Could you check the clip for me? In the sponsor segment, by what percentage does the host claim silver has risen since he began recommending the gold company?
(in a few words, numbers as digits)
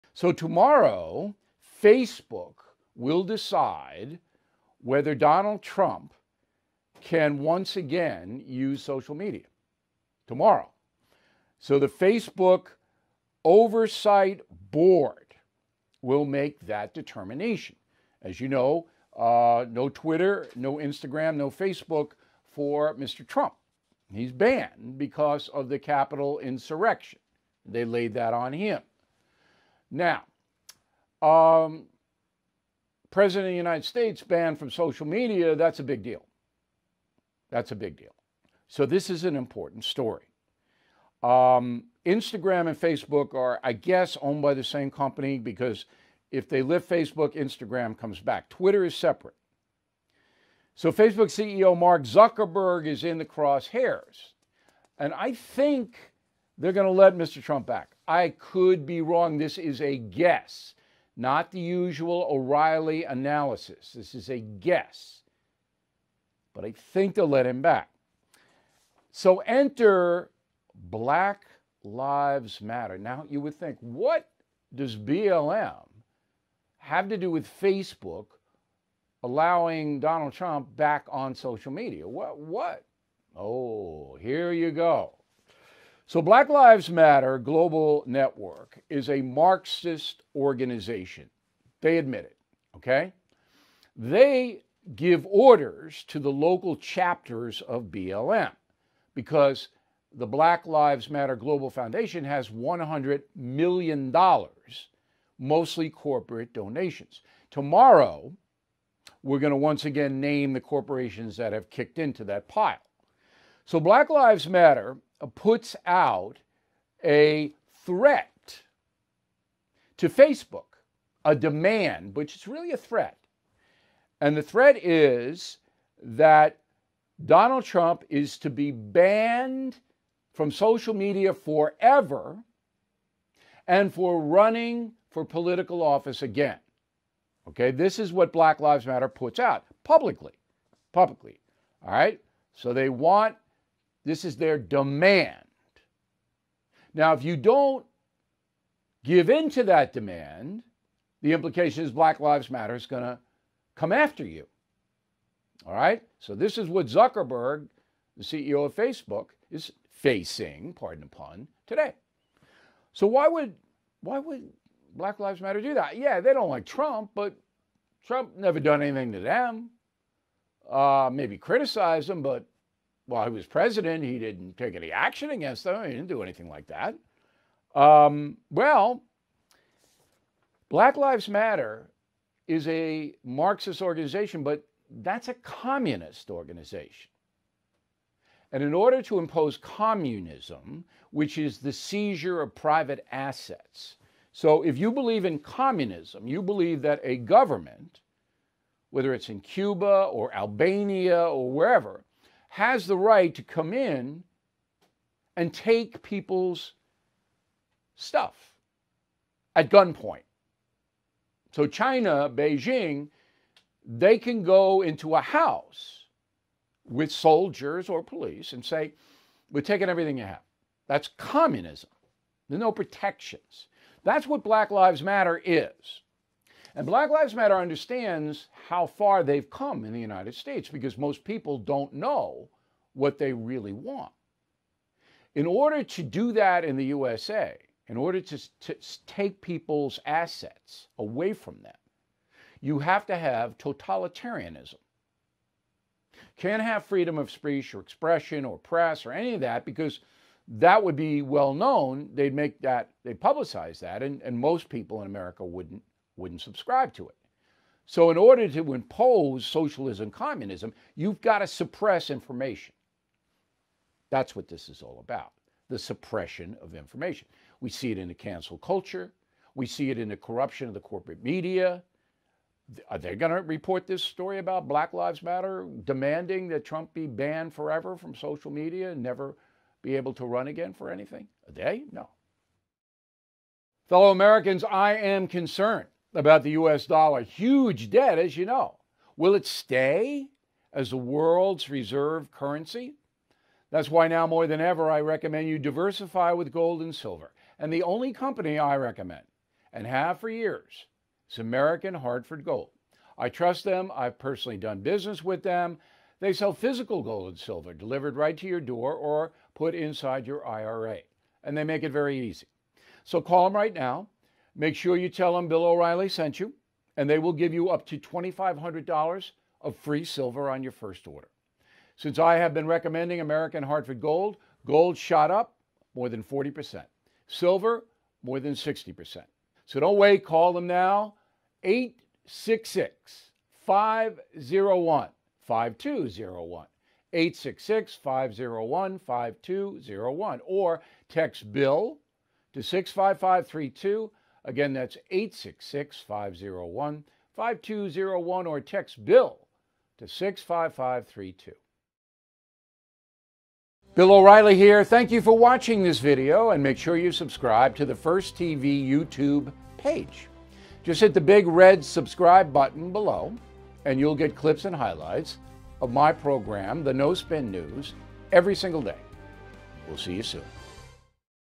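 60%.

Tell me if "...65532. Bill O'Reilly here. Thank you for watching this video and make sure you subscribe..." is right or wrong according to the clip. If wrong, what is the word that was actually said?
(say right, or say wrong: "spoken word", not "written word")
right.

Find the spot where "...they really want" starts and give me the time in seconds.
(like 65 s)
233 s.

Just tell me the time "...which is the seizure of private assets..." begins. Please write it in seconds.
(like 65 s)
191 s.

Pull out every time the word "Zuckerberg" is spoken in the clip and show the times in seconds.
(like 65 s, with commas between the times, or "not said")
52 s, 156 s.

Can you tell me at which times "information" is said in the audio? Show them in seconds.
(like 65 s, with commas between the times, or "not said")
262 s, 266 s.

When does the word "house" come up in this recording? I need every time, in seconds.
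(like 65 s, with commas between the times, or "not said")
215 s.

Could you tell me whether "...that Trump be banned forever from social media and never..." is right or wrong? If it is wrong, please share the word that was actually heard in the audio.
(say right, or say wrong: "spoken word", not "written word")
right.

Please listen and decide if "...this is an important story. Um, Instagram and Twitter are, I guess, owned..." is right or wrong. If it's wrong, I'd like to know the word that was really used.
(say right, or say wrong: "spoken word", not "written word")
wrong: "Facebook", not "Twitter".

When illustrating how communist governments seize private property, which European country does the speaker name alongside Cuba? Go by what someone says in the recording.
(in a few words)
Albania.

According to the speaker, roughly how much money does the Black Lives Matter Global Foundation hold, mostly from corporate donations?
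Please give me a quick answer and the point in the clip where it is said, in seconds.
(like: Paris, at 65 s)
$100 million, at 102 s.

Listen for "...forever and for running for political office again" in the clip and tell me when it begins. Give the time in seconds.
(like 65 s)
131 s.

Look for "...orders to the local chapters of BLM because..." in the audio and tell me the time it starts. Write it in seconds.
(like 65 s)
95 s.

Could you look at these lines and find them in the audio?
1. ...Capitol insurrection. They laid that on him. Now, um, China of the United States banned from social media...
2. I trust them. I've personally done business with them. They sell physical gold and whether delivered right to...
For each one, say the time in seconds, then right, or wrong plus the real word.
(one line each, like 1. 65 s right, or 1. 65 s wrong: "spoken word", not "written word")
1. 25 s wrong: "President", not "China"
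2. 303 s wrong: "silver", not "whether".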